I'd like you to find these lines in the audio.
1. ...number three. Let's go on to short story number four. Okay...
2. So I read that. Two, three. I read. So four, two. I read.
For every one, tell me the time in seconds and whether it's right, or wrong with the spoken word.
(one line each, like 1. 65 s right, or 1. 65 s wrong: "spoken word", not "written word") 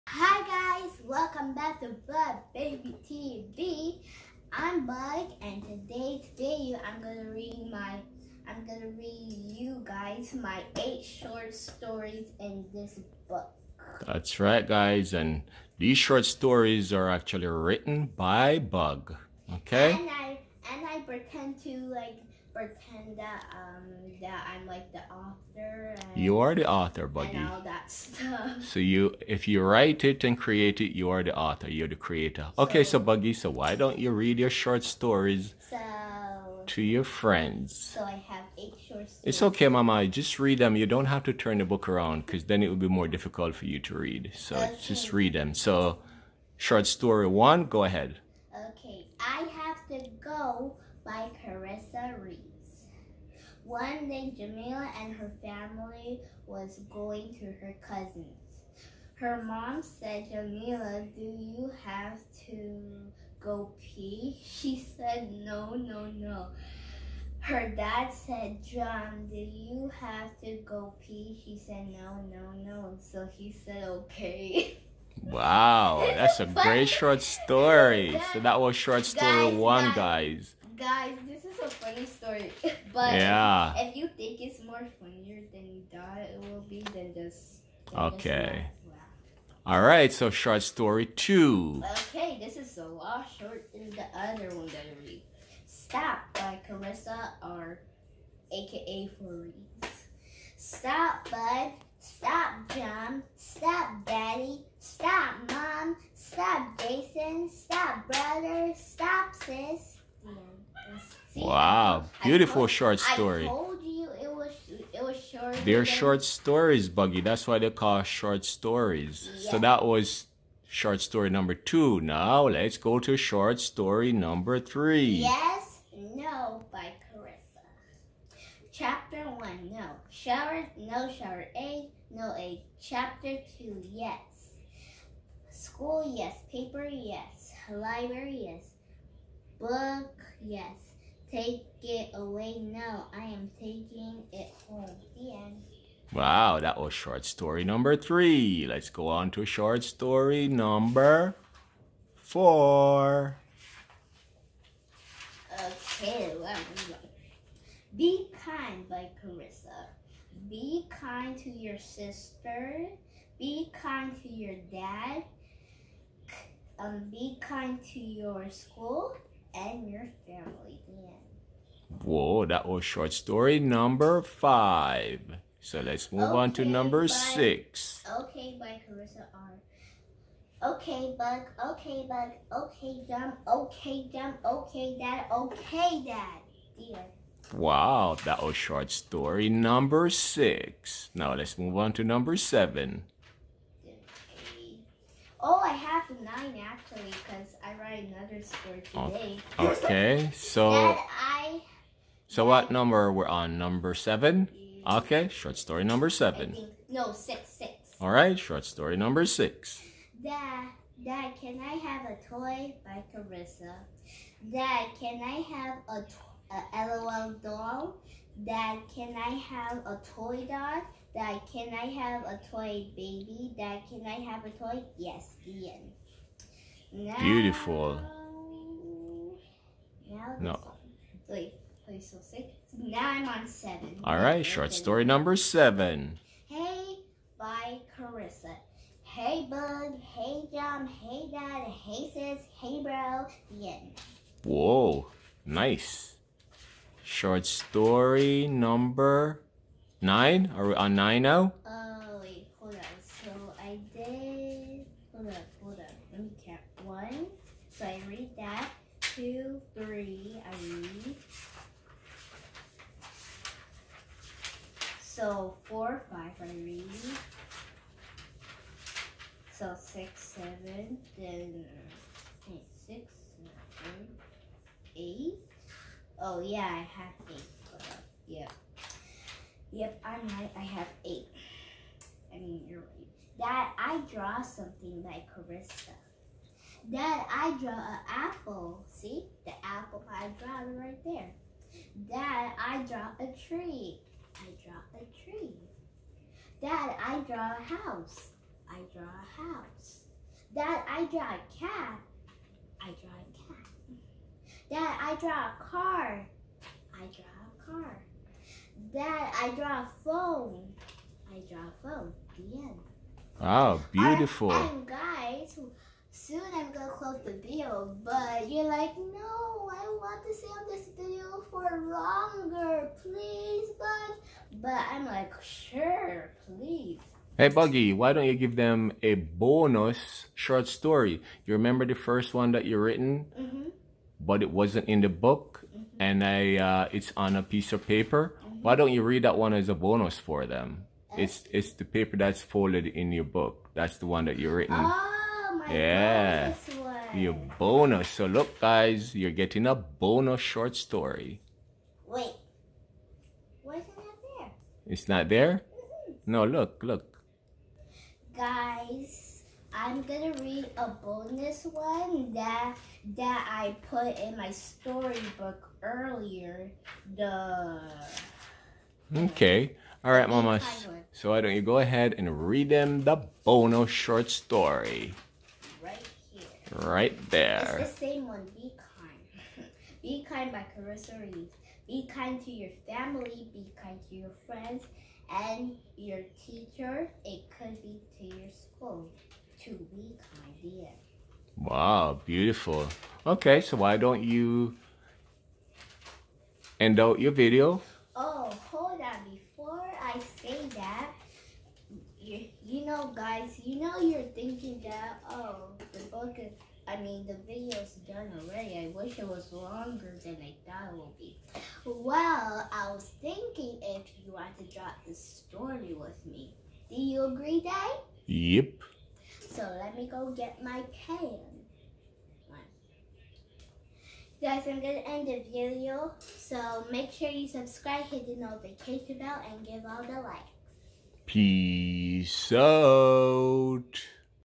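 1. 147 s right
2. 257 s wrong: "five", not "two".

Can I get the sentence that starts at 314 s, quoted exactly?
guys, soon I'm gonna close the video, but you're like, no, I want to stay on this video for longer, please, Bug.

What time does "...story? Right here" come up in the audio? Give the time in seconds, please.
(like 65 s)
374 s.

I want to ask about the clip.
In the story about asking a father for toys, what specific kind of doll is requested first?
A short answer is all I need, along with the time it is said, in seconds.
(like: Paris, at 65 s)
LOL doll, at 217 s.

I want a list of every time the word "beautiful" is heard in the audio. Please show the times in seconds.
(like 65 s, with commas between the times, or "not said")
112 s, 227 s, 313 s, 392 s.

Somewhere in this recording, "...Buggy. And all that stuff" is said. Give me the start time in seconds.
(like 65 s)
27 s.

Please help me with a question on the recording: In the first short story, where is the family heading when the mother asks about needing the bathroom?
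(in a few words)
Her cousin's.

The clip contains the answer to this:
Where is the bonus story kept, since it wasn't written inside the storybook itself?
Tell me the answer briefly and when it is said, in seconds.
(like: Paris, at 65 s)
On a piece of paper, at 337 s.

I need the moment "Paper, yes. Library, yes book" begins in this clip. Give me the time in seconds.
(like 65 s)
136 s.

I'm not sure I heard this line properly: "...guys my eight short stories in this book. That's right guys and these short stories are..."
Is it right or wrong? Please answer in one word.
right.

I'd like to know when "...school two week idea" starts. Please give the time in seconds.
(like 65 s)
388 s.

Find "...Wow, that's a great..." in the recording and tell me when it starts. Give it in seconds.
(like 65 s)
75 s.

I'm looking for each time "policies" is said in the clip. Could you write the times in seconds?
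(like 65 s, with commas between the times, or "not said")
not said.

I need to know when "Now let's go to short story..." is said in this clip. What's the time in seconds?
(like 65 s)
122 s.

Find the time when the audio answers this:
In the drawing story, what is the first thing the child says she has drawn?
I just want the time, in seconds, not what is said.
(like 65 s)
287 s.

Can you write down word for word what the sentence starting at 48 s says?
Okay, I have to go by Carissa Reeves.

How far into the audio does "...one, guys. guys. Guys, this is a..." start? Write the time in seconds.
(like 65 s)
79 s.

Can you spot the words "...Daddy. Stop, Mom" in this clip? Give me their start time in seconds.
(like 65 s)
104 s.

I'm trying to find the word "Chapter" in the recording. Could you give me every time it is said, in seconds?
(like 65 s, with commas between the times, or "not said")
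128 s, 132 s.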